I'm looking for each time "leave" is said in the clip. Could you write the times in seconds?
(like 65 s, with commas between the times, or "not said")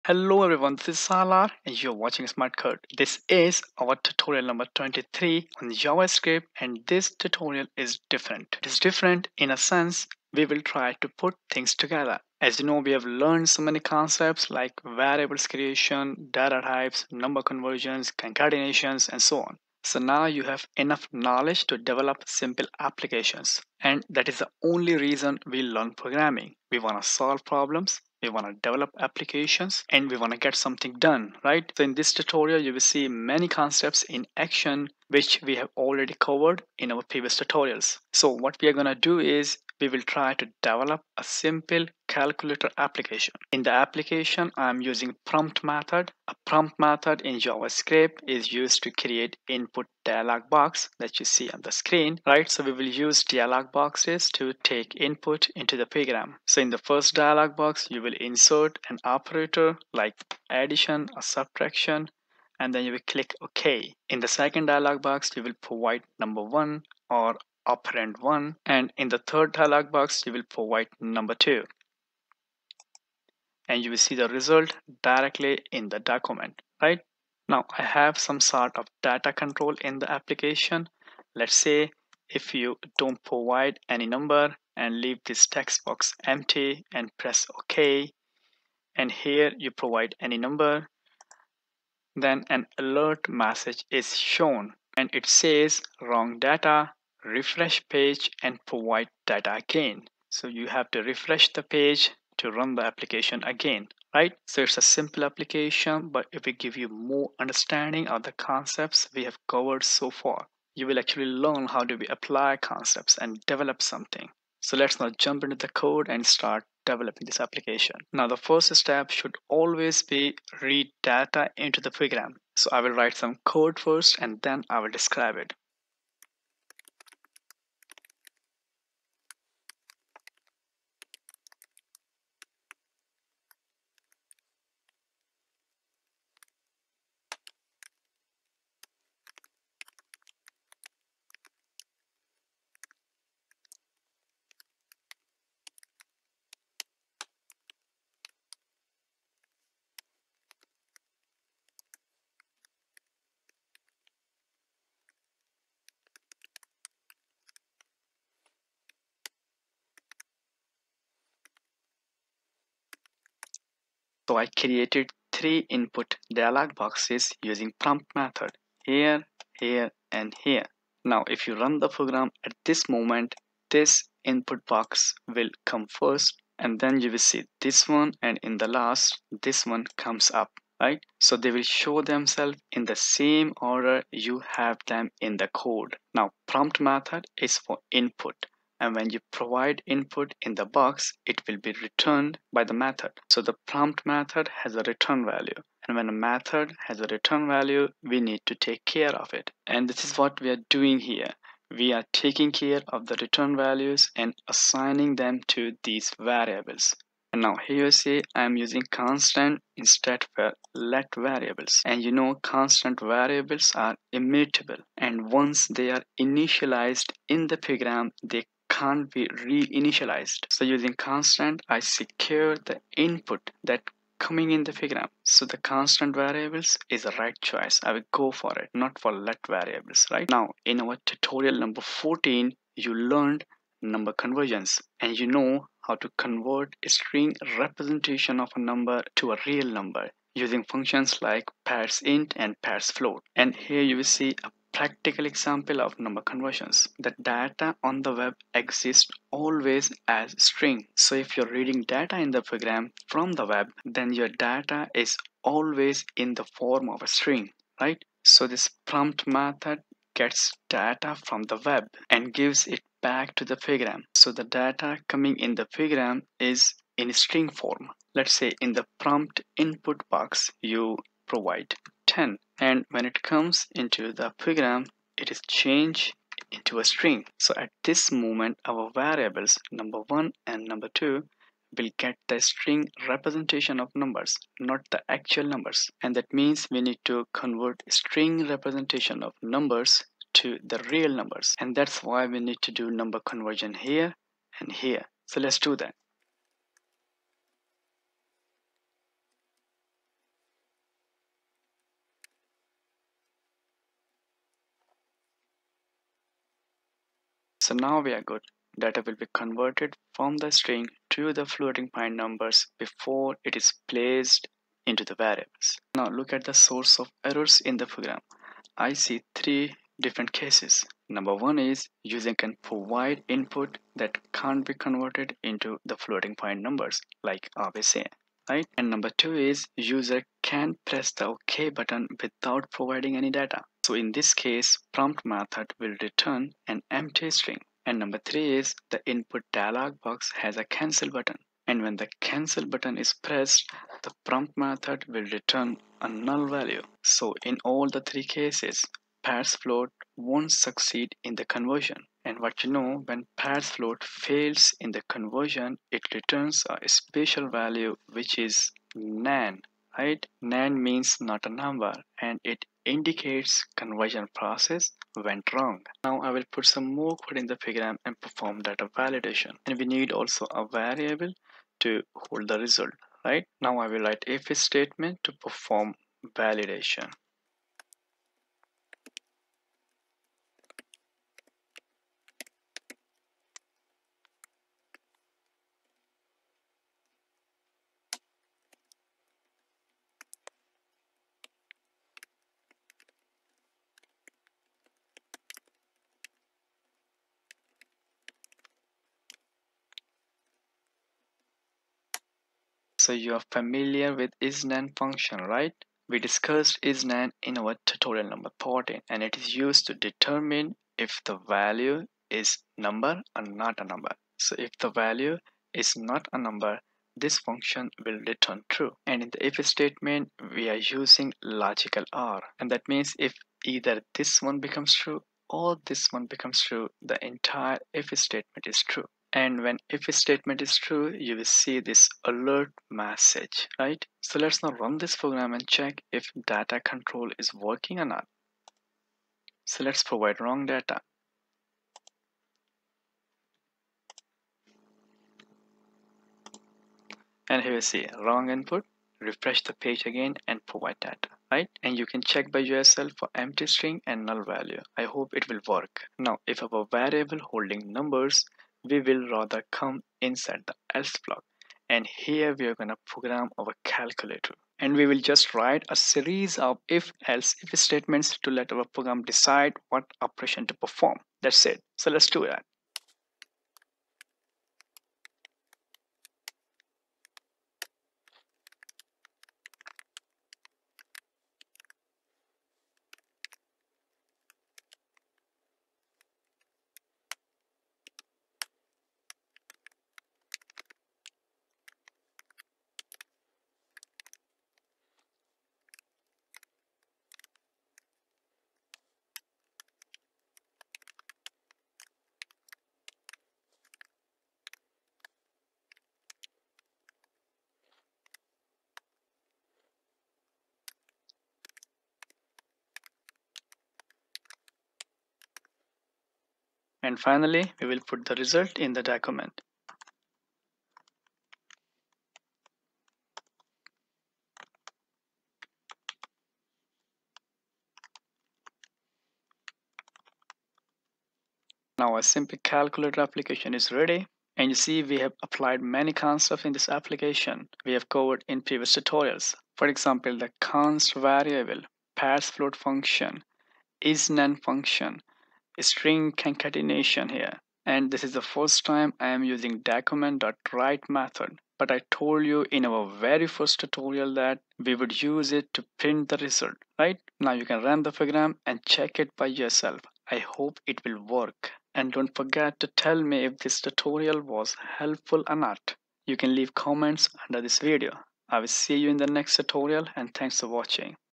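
85 s, 566 s.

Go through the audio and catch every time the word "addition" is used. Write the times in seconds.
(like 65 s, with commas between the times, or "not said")
60 s.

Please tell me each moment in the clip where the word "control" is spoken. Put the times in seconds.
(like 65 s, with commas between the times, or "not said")
79 s, 436 s.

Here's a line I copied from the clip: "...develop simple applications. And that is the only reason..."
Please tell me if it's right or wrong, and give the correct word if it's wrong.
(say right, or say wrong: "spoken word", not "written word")
right.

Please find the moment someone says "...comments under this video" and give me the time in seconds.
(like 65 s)
566 s.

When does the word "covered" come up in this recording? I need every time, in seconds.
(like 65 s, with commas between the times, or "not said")
36 s, 109 s, 538 s.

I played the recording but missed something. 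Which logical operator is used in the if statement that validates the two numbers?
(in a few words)
logical OR.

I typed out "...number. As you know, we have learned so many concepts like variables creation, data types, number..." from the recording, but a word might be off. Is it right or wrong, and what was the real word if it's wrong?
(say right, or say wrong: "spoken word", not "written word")
wrong: "together", not "number".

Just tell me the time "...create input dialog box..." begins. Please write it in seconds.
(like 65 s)
48 s.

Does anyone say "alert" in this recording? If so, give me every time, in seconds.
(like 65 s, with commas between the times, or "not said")
92 s, 432 s.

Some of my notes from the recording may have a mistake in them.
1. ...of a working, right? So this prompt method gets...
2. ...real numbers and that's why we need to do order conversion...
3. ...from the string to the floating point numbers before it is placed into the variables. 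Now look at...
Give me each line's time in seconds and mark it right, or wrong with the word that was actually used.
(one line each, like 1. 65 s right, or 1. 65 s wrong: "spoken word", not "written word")
1. 256 s wrong: "string", not "working"
2. 290 s wrong: "number", not "order"
3. 310 s right.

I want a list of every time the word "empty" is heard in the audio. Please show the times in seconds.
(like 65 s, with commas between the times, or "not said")
86 s, 336 s, 453 s.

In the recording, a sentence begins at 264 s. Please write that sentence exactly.
So the data coming in the program is in string form.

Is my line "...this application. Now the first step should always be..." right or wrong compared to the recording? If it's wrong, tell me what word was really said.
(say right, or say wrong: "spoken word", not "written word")
right.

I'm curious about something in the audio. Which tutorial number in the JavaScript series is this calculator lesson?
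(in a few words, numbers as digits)
23.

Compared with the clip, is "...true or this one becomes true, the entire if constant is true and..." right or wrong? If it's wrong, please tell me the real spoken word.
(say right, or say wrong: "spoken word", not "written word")
wrong: "statement", not "constant".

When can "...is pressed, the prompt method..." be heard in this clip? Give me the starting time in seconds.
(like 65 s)
342 s.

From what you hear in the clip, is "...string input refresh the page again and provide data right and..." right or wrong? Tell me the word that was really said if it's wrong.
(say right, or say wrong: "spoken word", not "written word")
wrong: "wrong", not "string".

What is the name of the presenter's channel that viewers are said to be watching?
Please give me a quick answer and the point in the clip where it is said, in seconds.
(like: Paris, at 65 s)
Smart Code, at 2 s.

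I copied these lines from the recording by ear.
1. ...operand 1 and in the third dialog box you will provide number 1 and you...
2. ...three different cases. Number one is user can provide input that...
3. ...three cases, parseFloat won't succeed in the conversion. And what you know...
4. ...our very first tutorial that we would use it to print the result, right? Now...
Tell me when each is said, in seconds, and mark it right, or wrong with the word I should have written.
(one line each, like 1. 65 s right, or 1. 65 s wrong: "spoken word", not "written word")
1. 67 s wrong: "2", not "1"
2. 319 s right
3. 347 s right
4. 552 s right.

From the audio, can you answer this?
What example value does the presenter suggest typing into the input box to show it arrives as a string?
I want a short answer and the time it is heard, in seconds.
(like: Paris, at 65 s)
10, at 272 s.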